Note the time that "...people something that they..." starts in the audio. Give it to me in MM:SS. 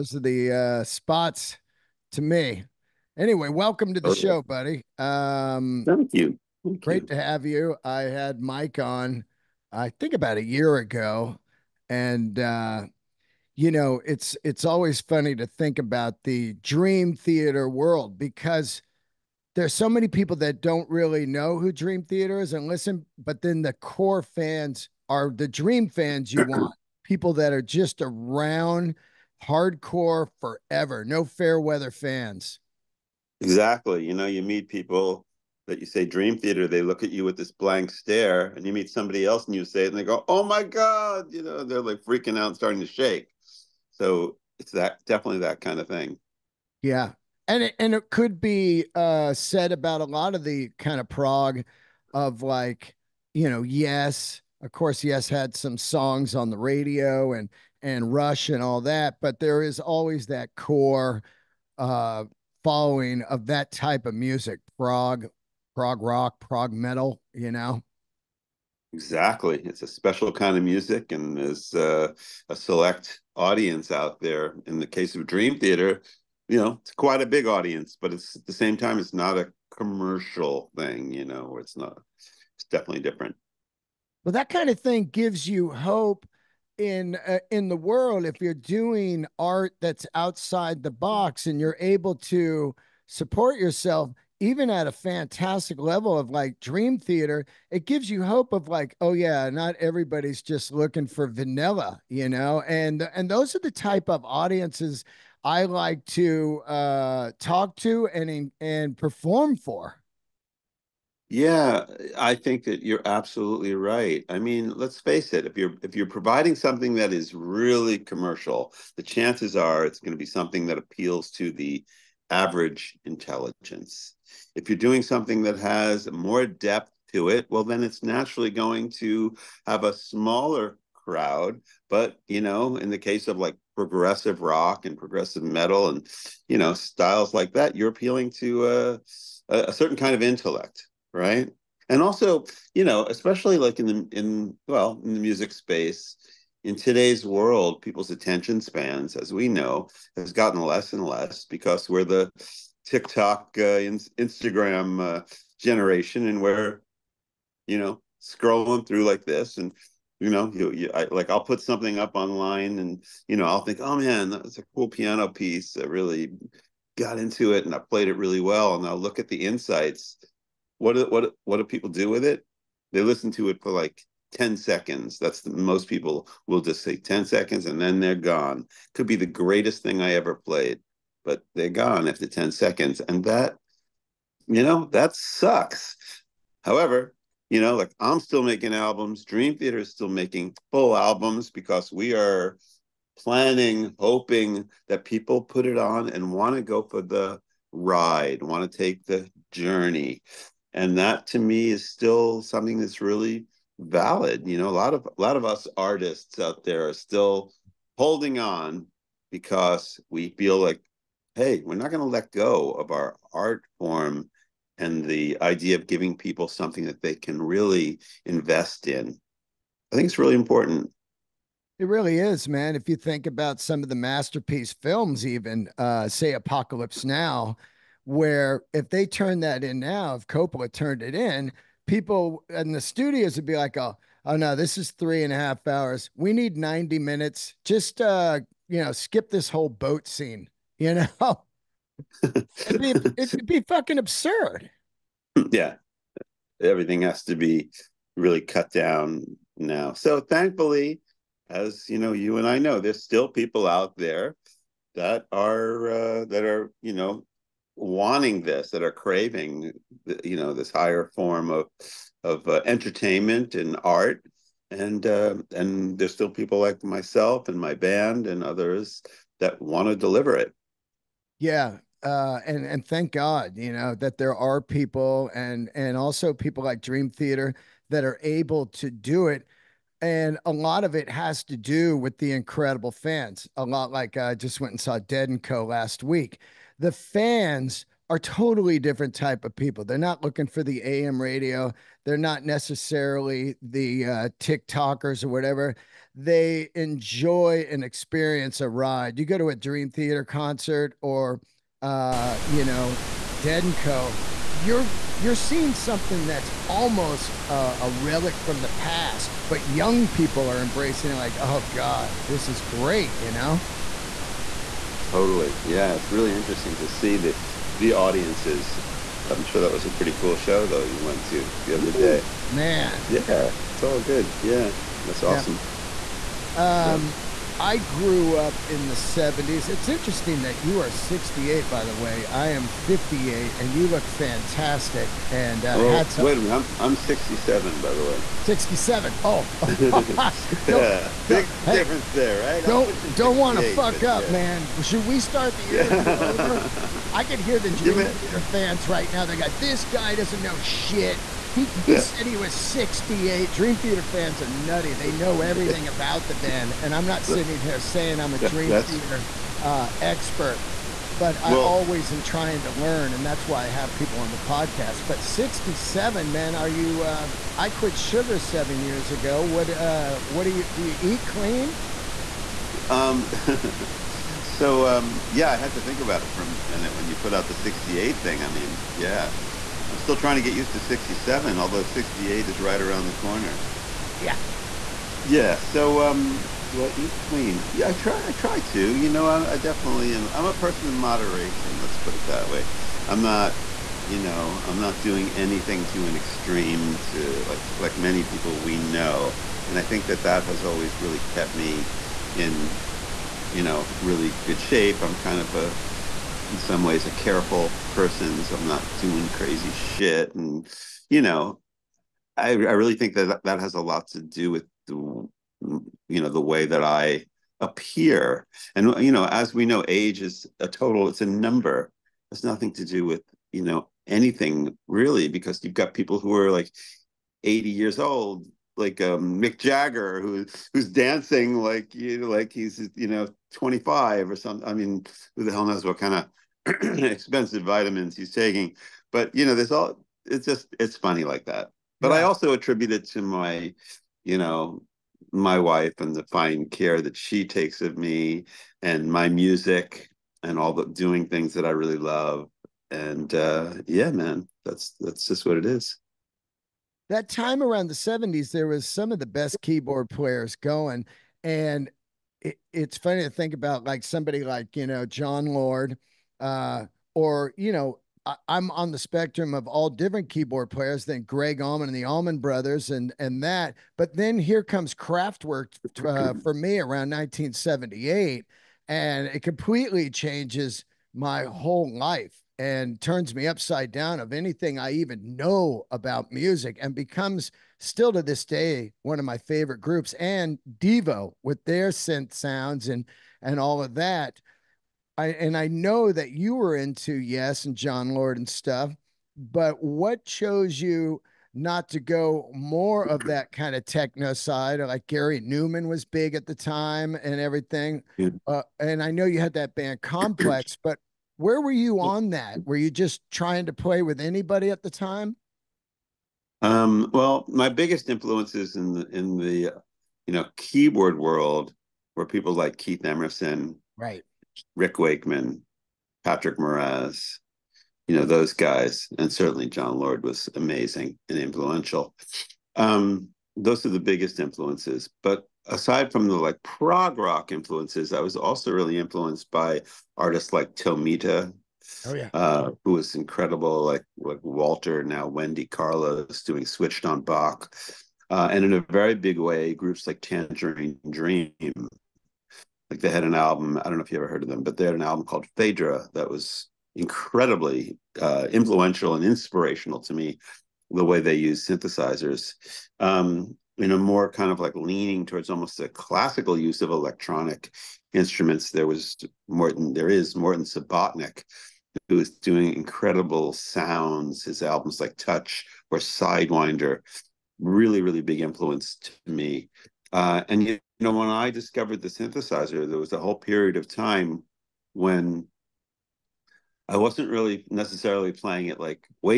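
03:36.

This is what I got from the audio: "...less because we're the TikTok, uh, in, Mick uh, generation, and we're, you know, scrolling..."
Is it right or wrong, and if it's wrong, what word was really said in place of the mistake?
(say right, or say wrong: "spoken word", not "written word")
wrong: "Instagram", not "Mick".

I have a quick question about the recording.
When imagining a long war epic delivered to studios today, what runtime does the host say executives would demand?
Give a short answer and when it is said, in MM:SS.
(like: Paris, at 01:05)
90 minutes, at 03:56.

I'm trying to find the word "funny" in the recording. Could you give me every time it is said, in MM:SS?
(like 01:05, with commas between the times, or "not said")
00:15, 07:20, 07:42.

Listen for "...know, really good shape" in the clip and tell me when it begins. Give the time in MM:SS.
06:43.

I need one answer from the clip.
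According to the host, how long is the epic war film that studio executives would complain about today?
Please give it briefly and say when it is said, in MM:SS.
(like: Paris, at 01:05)
three and a half hours, at 03:54.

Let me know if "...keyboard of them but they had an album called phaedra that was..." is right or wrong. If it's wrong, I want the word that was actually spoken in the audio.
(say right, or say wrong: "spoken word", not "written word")
wrong: "heard", not "keyboard".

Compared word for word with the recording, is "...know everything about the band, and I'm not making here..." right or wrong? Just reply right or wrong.
wrong.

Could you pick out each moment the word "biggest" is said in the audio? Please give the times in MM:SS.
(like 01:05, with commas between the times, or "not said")
08:37, 08:54.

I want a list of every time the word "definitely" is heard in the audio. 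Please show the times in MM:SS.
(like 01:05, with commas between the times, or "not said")
00:45, 01:22, 06:29.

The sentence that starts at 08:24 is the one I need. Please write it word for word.
Like Gary Newman was big at the time and everything.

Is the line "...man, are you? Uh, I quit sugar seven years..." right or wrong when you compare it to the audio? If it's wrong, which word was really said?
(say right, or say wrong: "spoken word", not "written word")
right.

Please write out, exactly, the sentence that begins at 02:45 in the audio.
I really got into it, and I played it really well, and I'll look at the insights.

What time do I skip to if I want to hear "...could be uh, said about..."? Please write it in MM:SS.
00:48.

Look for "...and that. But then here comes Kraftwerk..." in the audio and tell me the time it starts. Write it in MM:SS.
07:53.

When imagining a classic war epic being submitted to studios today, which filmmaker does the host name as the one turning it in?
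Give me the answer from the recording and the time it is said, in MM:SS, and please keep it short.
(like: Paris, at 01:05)
Coppola, at 03:50.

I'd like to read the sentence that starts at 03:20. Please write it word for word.
And that to me is still something that's really valid.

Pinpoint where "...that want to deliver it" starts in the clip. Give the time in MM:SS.
04:29.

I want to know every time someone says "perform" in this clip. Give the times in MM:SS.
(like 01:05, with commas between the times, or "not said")
01:48.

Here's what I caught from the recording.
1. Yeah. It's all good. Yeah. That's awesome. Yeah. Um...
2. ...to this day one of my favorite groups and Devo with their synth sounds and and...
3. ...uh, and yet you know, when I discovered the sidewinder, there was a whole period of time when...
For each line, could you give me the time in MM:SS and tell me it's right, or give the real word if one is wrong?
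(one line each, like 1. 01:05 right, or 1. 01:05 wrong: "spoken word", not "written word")
1. 05:23 right
2. 08:08 right
3. 09:40 wrong: "synthesizer", not "sidewinder".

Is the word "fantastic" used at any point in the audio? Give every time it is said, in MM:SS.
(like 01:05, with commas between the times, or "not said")
01:34, 05:34.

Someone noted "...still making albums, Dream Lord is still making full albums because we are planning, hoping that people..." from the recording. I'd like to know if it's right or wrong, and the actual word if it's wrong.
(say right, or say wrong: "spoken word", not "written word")
wrong: "Theater", not "Lord".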